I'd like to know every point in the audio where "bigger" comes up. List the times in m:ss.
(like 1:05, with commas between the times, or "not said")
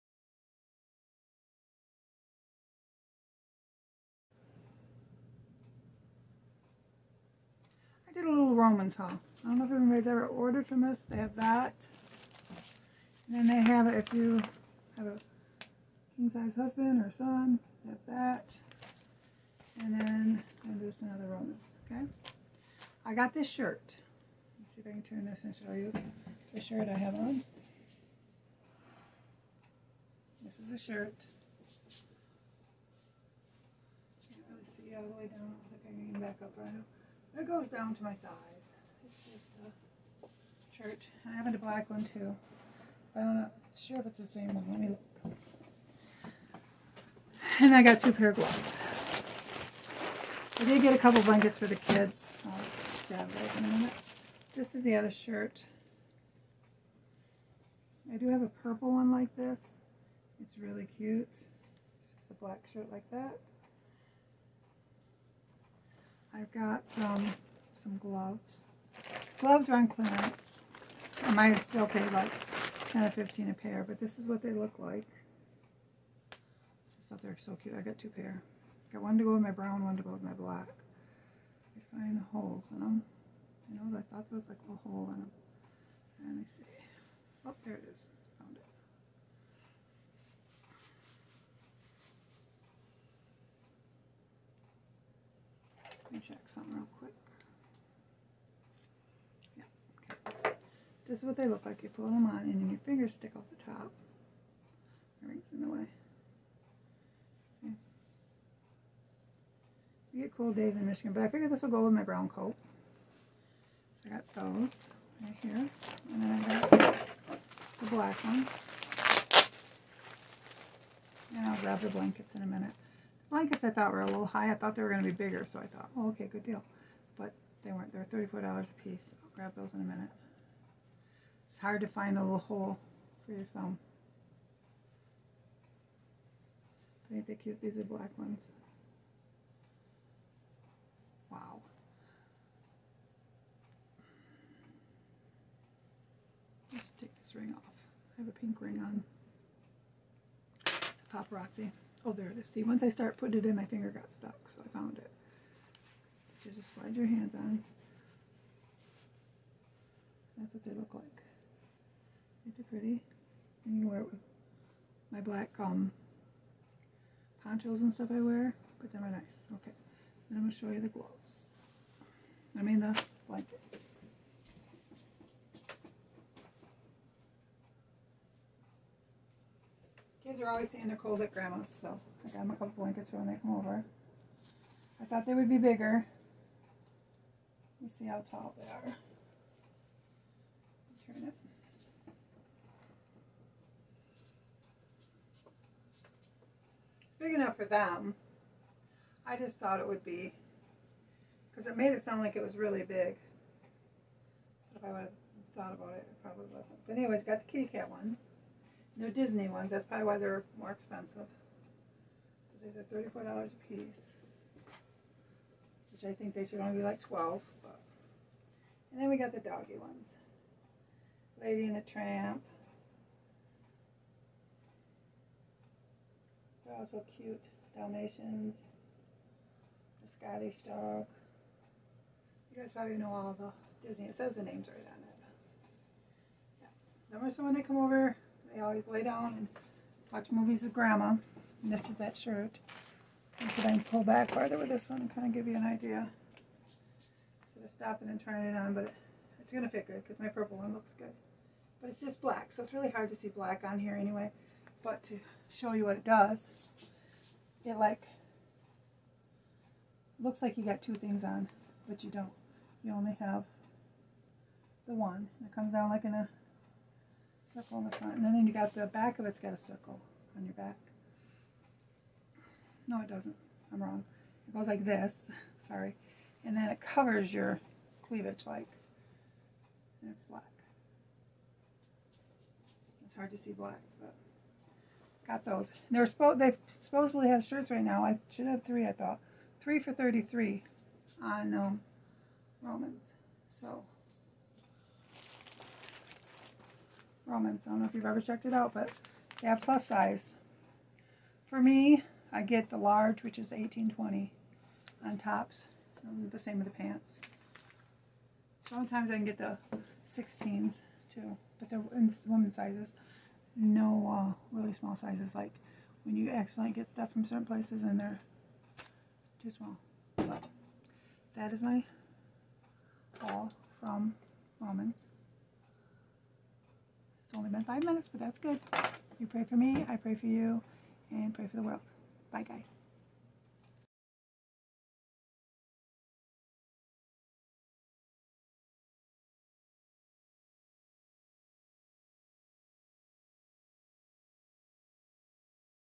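2:05, 3:05.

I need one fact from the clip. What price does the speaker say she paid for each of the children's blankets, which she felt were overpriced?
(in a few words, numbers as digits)
$34.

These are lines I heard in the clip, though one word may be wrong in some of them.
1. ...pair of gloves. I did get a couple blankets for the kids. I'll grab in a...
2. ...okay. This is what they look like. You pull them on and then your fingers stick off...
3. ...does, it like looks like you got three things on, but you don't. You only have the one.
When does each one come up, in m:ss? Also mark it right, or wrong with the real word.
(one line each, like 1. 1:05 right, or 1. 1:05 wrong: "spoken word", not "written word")
1. 0:48 right
2. 1:40 right
3. 4:16 wrong: "two", not "three".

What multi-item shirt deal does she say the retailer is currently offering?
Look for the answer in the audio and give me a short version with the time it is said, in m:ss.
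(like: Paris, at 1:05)
3 for $33, at 4:49.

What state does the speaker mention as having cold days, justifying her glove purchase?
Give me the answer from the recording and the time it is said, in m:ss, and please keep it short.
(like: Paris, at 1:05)
Michigan, at 1:50.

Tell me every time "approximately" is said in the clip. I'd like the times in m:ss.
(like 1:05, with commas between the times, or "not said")
not said.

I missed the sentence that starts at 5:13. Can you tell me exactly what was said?
No uh, really small sizes, like when you accidentally get stuff from certain places and they're too small.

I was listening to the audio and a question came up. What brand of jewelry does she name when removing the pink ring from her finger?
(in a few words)
Paparazzi.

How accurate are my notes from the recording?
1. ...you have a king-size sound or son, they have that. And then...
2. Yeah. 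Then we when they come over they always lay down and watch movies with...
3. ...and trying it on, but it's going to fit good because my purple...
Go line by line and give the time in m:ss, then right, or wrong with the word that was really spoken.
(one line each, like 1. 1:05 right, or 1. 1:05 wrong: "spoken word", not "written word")
1. 0:14 wrong: "husband", not "sound"
2. 3:56 right
3. 4:08 right.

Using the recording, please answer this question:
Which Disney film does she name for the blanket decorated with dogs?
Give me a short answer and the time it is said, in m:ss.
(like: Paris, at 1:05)
Lady and the Tramp, at 3:41.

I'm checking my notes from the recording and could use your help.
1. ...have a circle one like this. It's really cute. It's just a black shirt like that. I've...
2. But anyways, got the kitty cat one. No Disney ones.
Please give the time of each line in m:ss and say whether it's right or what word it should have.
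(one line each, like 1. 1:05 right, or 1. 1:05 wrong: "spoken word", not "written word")
1. 0:58 wrong: "purple", not "circle"
2. 3:26 right.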